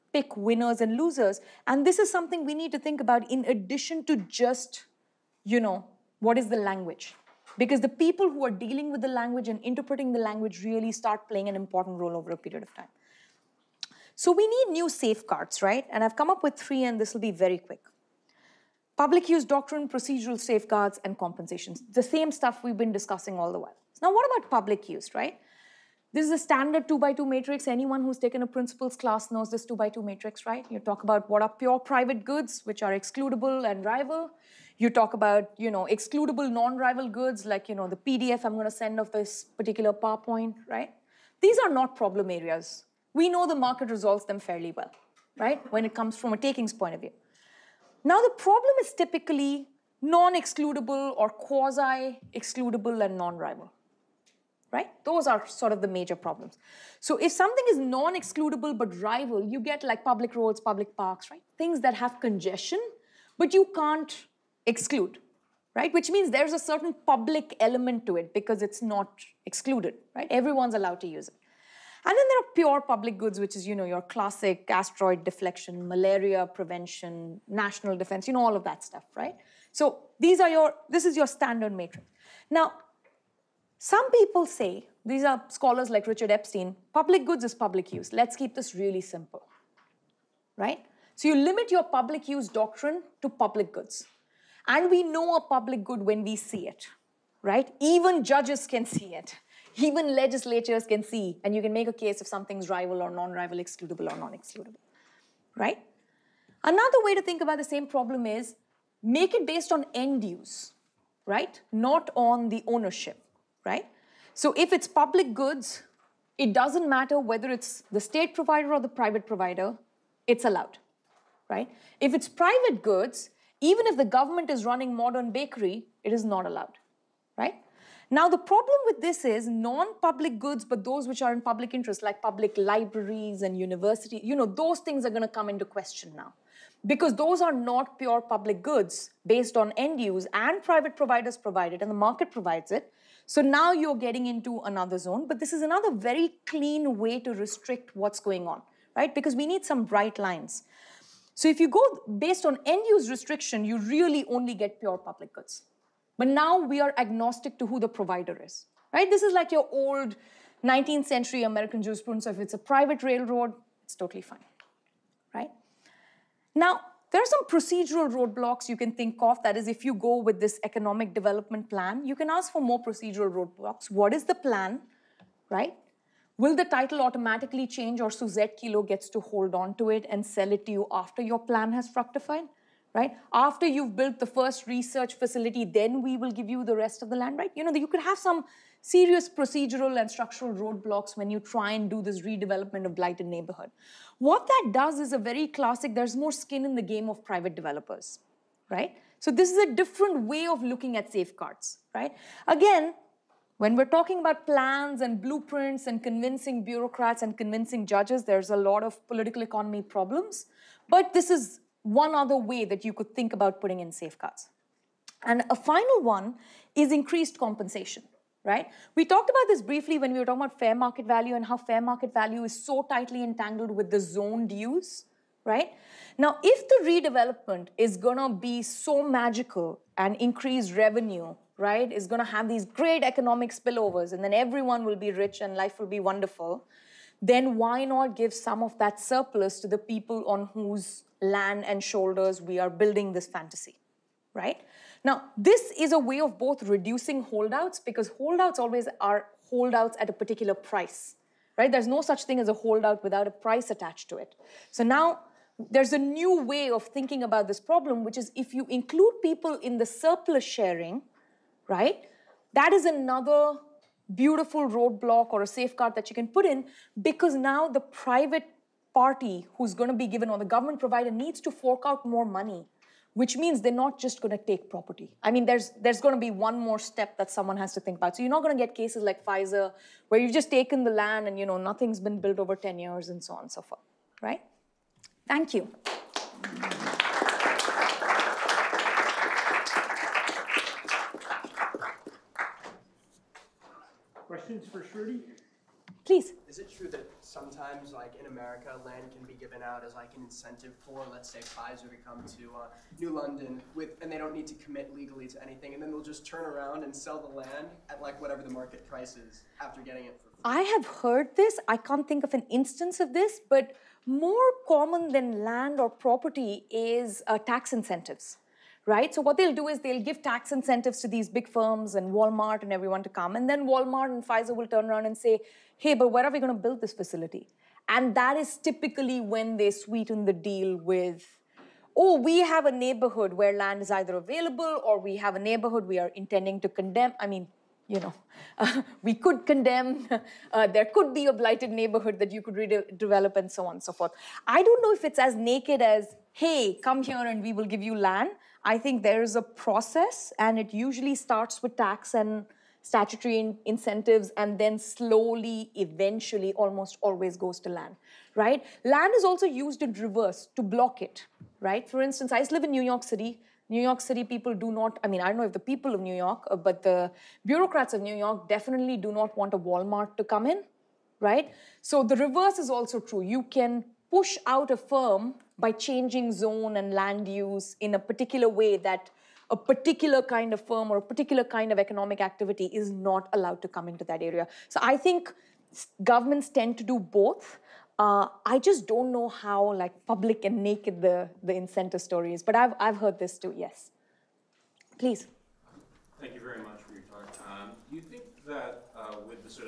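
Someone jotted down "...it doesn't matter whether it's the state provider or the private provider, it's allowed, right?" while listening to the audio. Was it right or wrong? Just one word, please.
right.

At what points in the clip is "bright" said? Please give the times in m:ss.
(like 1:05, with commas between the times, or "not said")
2:29.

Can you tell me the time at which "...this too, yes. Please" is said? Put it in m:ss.
6:33.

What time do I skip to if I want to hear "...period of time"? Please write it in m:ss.
0:12.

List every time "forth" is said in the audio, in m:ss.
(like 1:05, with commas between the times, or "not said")
4:43, 5:43.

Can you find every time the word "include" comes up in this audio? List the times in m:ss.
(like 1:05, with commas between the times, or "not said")
4:18.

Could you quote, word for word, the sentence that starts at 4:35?
I mean, there's there's going to be one more step that someone has to think about.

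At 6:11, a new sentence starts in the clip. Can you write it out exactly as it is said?
So the reverse is also true.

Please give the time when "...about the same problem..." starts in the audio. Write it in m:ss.
1:47.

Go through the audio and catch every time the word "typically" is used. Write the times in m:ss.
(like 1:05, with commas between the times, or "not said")
0:48, 5:28.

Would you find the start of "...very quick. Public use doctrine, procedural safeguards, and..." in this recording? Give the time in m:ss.
0:17.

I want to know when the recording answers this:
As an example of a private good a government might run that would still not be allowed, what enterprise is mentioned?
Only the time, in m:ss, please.
2:04.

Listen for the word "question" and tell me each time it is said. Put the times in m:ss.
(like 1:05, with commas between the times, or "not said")
2:15, 4:54.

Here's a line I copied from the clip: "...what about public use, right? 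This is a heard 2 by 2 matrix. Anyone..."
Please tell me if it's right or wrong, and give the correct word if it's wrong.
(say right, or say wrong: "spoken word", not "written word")
wrong: "standard", not "heard".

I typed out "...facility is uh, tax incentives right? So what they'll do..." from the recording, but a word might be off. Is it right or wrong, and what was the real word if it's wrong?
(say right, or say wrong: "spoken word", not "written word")
wrong: "property", not "facility".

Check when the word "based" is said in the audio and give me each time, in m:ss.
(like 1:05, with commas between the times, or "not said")
1:49, 2:19, 2:32.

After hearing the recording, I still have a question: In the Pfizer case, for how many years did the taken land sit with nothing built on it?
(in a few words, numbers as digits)
10.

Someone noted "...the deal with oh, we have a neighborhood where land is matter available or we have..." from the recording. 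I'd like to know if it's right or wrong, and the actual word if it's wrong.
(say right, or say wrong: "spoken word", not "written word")
wrong: "either", not "matter".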